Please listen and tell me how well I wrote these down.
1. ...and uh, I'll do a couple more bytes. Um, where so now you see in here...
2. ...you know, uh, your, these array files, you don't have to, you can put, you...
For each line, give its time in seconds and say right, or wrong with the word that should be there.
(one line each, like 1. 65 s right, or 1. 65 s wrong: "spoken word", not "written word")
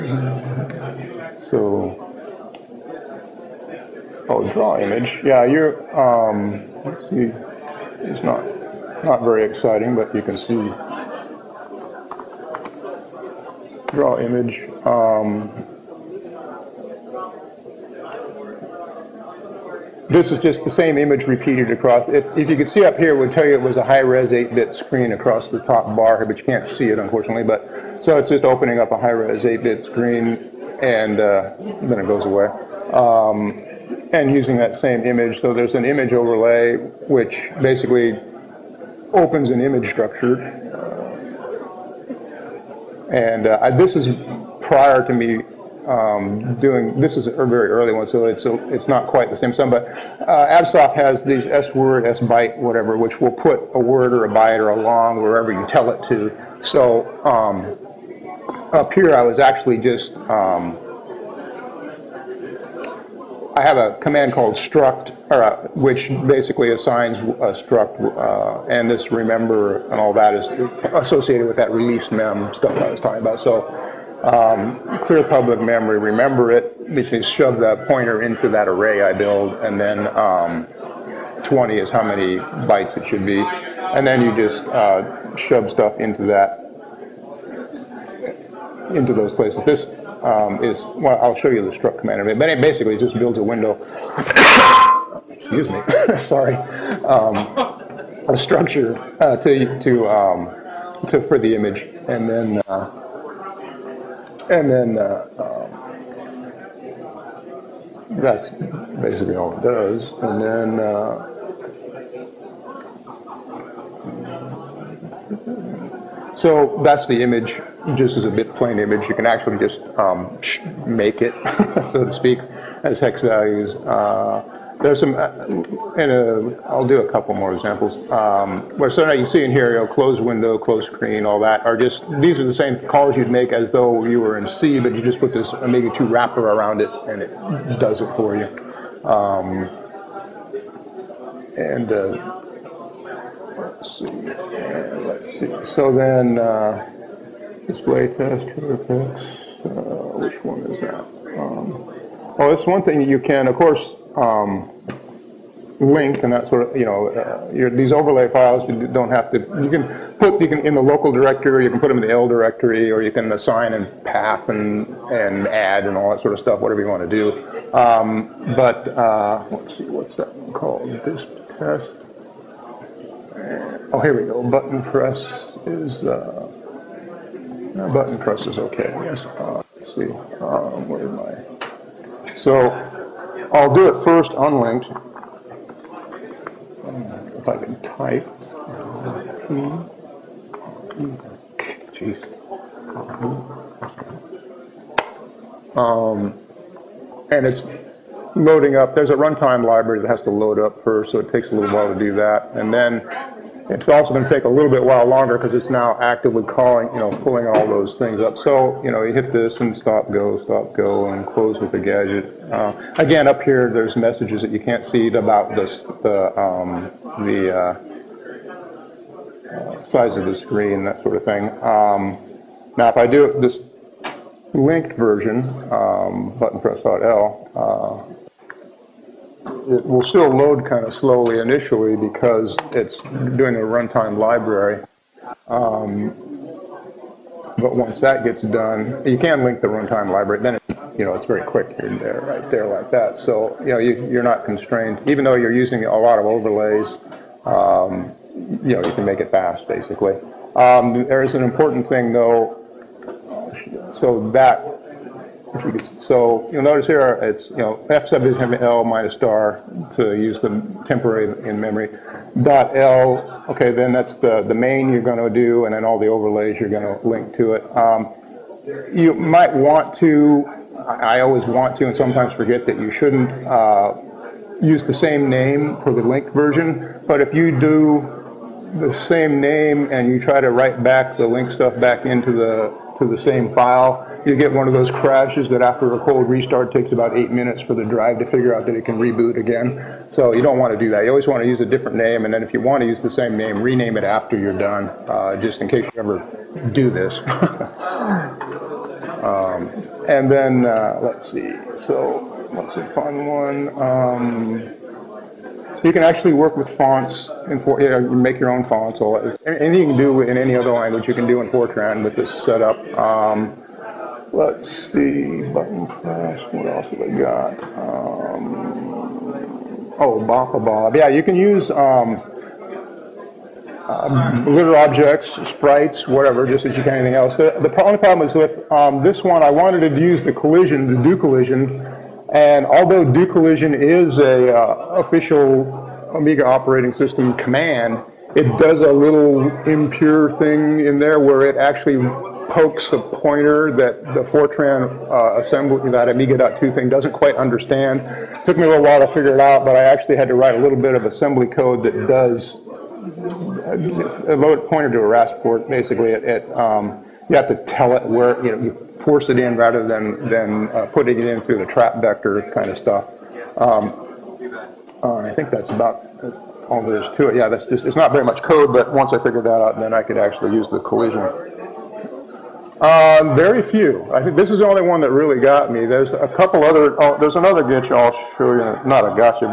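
1. 125 s wrong: "examples", not "bytes"
2. 156 s wrong: "overlay", not "array".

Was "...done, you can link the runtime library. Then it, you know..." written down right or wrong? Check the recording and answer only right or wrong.
right.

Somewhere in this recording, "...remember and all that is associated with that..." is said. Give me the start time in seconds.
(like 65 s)
69 s.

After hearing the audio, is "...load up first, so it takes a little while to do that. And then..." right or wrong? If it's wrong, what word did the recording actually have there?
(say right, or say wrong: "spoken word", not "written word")
right.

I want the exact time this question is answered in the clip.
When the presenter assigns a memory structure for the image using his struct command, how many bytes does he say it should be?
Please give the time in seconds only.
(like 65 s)
81 s.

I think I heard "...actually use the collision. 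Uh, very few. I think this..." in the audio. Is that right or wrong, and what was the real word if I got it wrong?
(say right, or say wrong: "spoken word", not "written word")
right.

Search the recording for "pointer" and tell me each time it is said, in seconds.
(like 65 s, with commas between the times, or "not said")
77 s, 342 s, 354 s.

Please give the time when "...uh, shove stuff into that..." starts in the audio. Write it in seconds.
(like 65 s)
84 s.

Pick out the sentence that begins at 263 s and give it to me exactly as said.
Okay, then that's the the main you're going to do, and then all the overlays you're going to link to it.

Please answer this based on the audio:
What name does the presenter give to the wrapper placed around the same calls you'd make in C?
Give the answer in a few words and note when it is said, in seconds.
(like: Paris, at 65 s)
Amiga 2, at 135 s.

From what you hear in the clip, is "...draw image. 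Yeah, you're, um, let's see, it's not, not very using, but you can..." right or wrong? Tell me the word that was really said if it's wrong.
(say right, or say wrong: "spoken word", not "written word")
wrong: "exciting", not "using".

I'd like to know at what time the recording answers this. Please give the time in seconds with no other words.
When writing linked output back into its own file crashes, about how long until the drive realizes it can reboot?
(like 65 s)
287 s.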